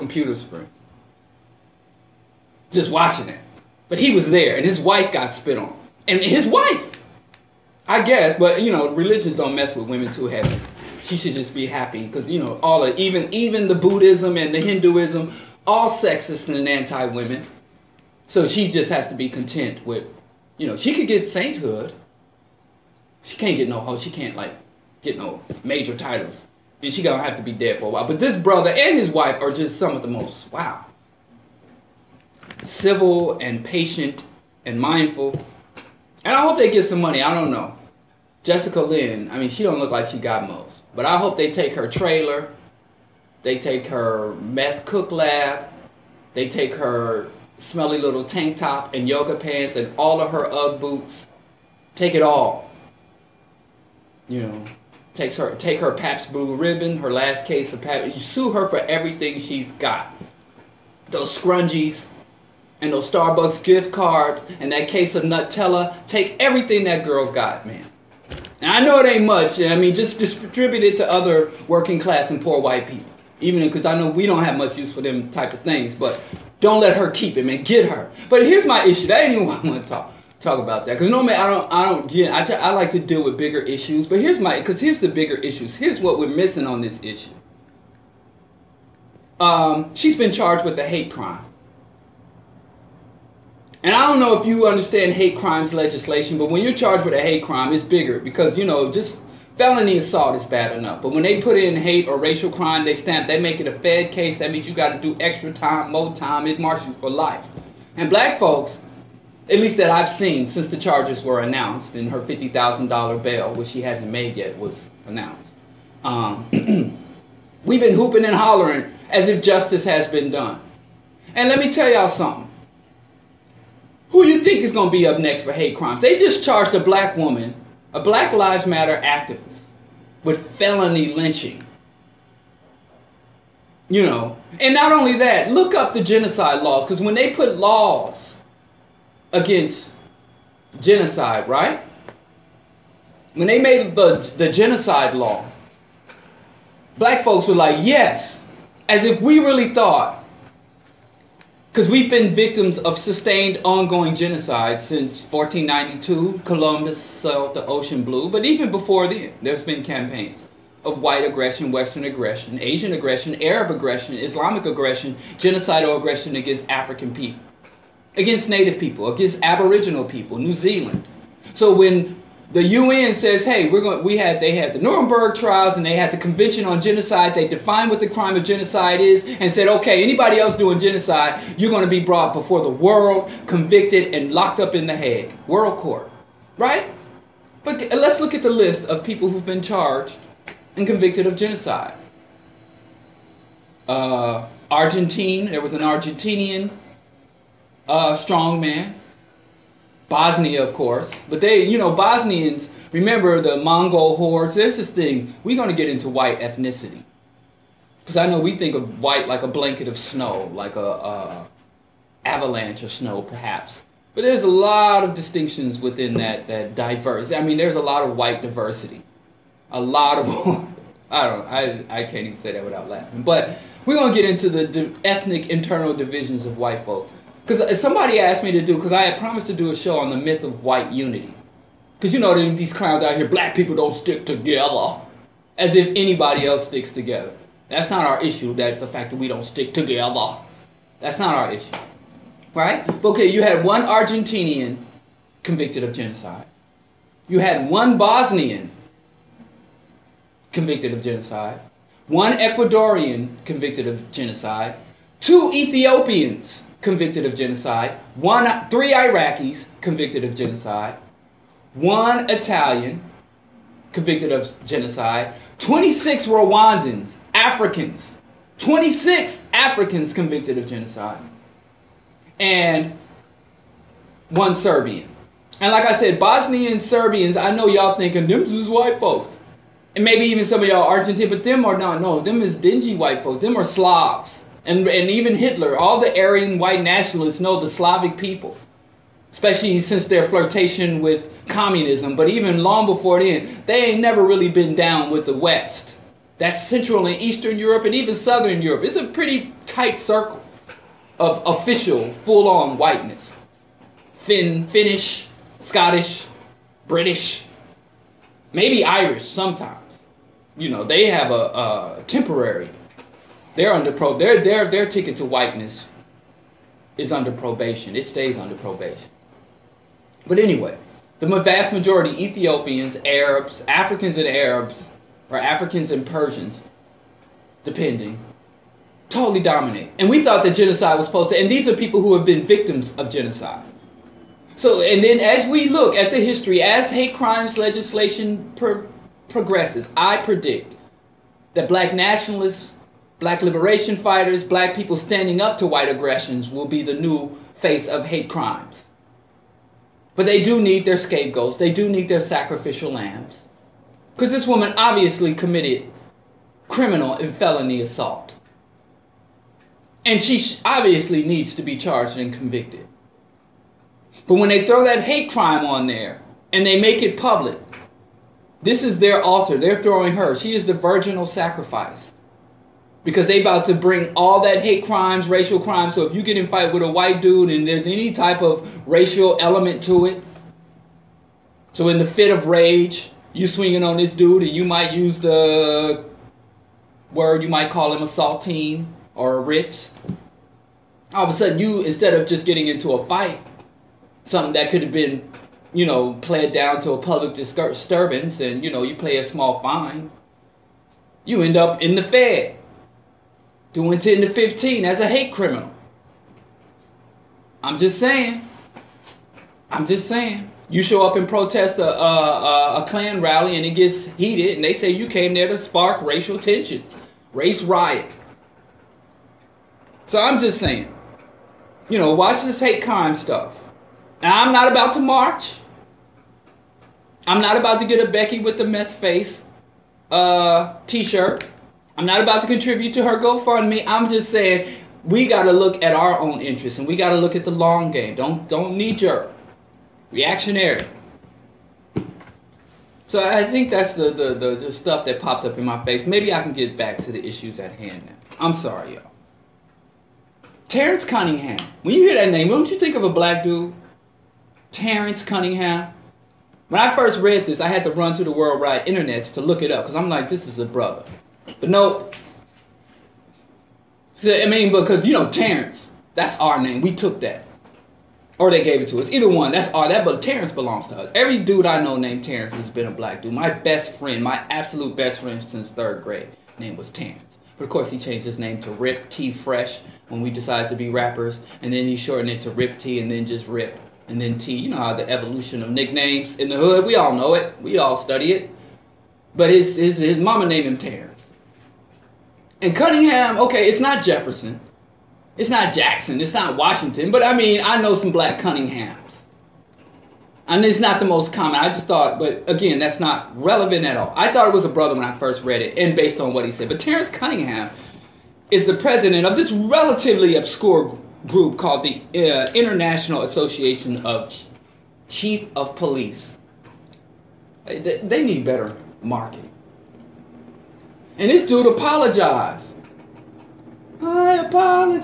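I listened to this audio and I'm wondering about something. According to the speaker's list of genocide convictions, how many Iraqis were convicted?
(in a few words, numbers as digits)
three.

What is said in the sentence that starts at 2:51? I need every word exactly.
So when the UN says, hey, we're going.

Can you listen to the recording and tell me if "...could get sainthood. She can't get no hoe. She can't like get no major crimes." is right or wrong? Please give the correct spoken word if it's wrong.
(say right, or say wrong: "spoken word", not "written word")
wrong: "titles", not "crimes".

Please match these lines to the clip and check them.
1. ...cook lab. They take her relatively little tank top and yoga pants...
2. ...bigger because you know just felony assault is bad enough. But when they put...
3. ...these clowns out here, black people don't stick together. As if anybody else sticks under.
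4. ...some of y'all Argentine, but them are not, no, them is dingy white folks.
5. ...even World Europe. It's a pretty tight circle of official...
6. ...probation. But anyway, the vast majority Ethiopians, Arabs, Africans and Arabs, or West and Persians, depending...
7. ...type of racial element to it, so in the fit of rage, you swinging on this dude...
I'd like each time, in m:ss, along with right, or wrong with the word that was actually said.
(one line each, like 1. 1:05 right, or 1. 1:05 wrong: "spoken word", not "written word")
1. 0:44 wrong: "smelly", not "relatively"
2. 1:37 right
3. 3:52 wrong: "together", not "under"
4. 4:40 right
5. 4:57 wrong: "Southern", not "World"
6. 5:18 wrong: "Africans", not "West"
7. 6:18 right.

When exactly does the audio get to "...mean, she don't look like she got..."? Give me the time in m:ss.
0:39.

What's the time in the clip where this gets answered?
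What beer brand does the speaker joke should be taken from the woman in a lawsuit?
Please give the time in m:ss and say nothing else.
0:55.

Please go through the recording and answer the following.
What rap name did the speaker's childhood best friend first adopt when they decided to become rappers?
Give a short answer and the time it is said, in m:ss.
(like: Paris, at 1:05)
Rip T Fresh, at 7:58.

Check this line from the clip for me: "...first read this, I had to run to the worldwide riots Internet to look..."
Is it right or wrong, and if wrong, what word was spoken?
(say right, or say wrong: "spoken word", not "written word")
wrong: "internets", not "riots".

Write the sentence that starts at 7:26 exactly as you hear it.
Maybe I can get back to the issues at hand now.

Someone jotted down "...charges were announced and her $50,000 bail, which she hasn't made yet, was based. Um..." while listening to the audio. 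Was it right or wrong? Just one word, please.
wrong.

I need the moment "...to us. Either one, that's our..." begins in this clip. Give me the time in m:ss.
7:48.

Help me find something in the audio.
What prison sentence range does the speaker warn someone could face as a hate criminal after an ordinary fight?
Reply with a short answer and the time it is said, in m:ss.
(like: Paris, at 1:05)
10 to 15, at 6:43.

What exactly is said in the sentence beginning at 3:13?
Uh, Argentine, there was an Argentinian uh, strongman Bosnia, of course.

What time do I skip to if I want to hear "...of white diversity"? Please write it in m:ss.
3:38.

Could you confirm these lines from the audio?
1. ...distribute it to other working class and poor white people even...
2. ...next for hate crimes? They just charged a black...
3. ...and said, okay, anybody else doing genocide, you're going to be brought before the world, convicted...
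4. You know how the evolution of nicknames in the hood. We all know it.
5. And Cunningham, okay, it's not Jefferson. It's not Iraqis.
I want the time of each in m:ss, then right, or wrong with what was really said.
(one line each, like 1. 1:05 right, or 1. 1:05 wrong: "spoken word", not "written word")
1. 1:10 right
2. 2:05 right
3. 2:59 right
4. 8:04 right
5. 8:12 wrong: "Jackson", not "Iraqis".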